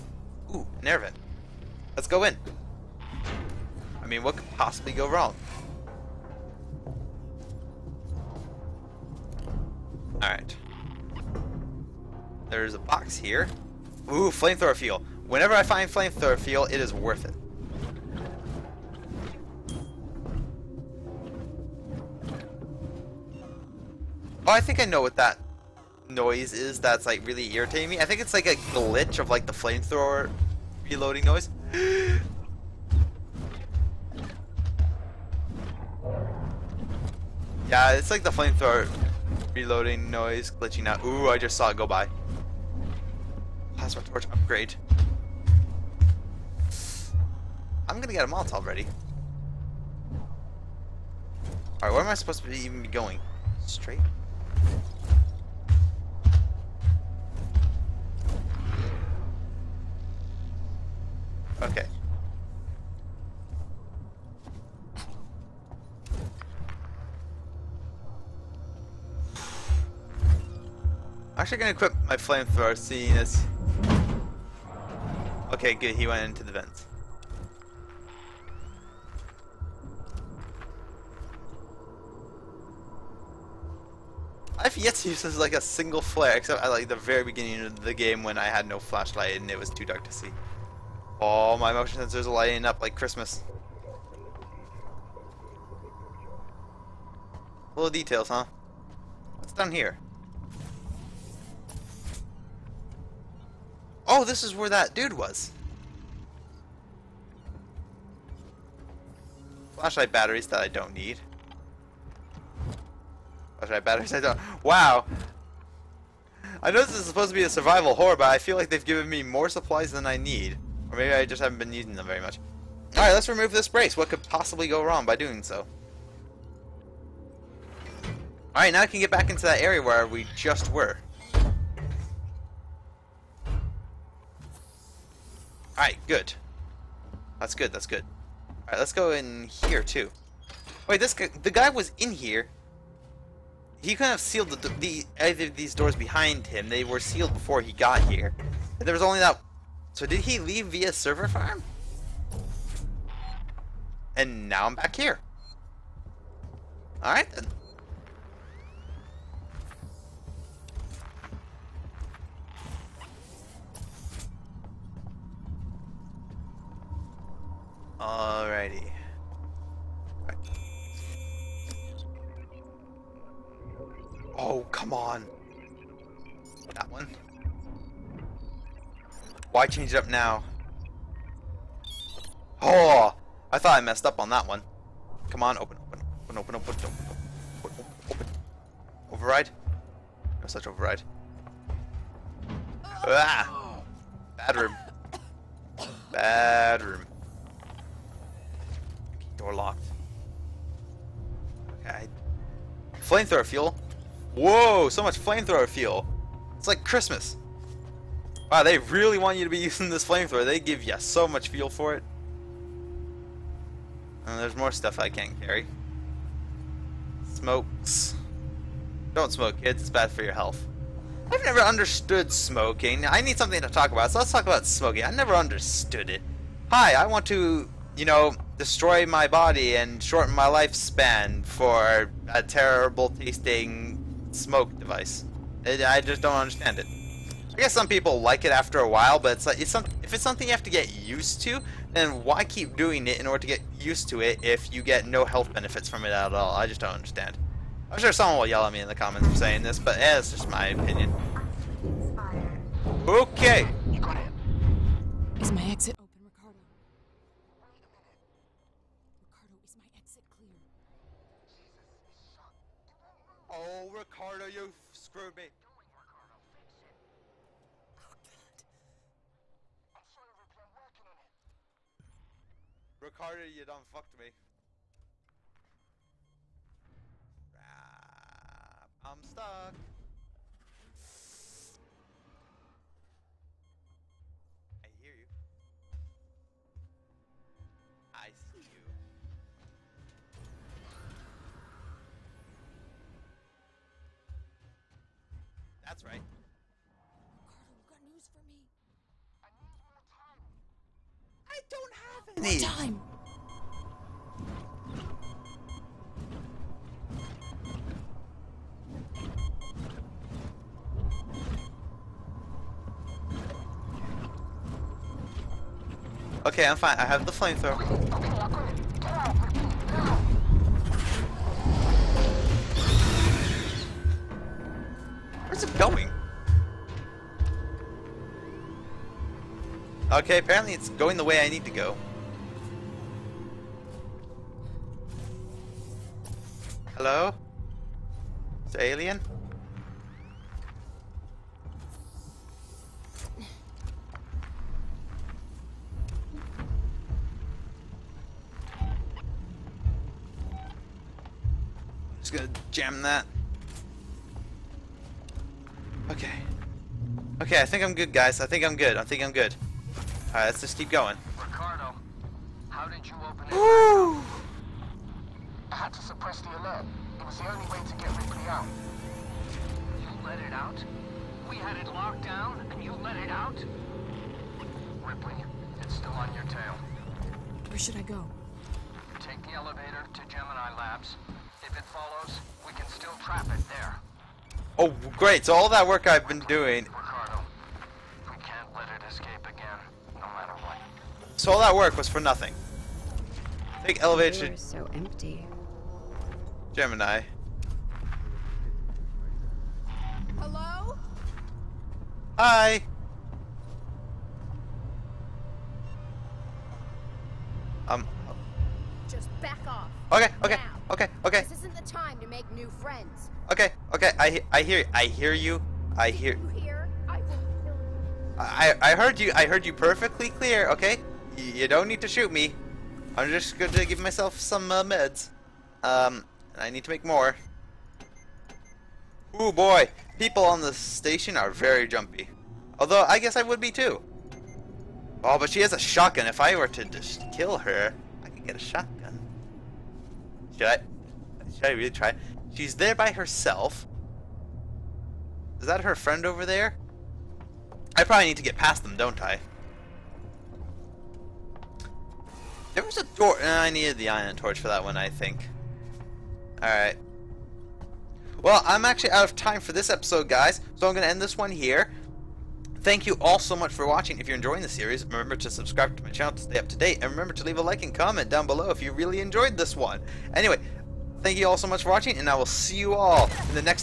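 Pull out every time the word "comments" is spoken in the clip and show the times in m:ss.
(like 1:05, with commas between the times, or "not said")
4:08, 7:47.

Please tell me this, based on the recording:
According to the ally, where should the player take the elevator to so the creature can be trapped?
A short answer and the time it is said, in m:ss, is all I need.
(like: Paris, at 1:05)
Gemini Labs, at 6:20.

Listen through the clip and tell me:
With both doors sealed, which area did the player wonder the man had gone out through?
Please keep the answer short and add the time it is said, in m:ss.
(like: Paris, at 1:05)
Server farm, at 2:30.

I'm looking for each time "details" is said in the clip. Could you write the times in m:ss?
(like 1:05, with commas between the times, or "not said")
1:37.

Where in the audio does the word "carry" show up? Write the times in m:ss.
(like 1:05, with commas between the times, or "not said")
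3:35.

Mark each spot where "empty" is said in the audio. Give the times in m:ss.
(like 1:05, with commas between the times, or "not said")
6:34.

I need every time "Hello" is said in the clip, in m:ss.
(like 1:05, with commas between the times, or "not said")
5:36, 6:40.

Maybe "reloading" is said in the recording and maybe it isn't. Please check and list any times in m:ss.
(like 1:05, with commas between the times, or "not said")
0:30, 0:39.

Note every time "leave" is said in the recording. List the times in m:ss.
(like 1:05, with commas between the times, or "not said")
2:30, 7:47.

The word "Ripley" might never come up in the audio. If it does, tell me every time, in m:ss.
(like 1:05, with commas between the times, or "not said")
6:08, 6:15.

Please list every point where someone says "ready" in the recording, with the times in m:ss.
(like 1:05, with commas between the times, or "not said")
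0:48.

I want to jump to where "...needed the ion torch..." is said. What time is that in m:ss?
7:33.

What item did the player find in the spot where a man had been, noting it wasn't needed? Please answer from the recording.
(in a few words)
Flashlight batteries.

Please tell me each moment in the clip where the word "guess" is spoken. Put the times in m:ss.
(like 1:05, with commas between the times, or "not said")
3:57, 7:13.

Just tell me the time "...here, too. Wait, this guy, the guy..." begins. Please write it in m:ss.
2:19.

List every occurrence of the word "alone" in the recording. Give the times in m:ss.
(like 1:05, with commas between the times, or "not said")
not said.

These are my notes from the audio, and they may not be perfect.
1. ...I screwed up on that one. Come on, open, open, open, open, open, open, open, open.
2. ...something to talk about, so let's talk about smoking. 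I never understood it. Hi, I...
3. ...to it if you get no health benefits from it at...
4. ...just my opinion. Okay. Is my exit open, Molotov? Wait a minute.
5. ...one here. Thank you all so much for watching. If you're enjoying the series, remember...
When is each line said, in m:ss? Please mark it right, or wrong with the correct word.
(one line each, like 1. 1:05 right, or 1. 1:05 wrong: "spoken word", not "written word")
1. 3:03 wrong: "messed", not "screwed"
2. 3:43 right
3. 4:04 right
4. 4:10 wrong: "Ricardo", not "Molotov"
5. 7:41 right.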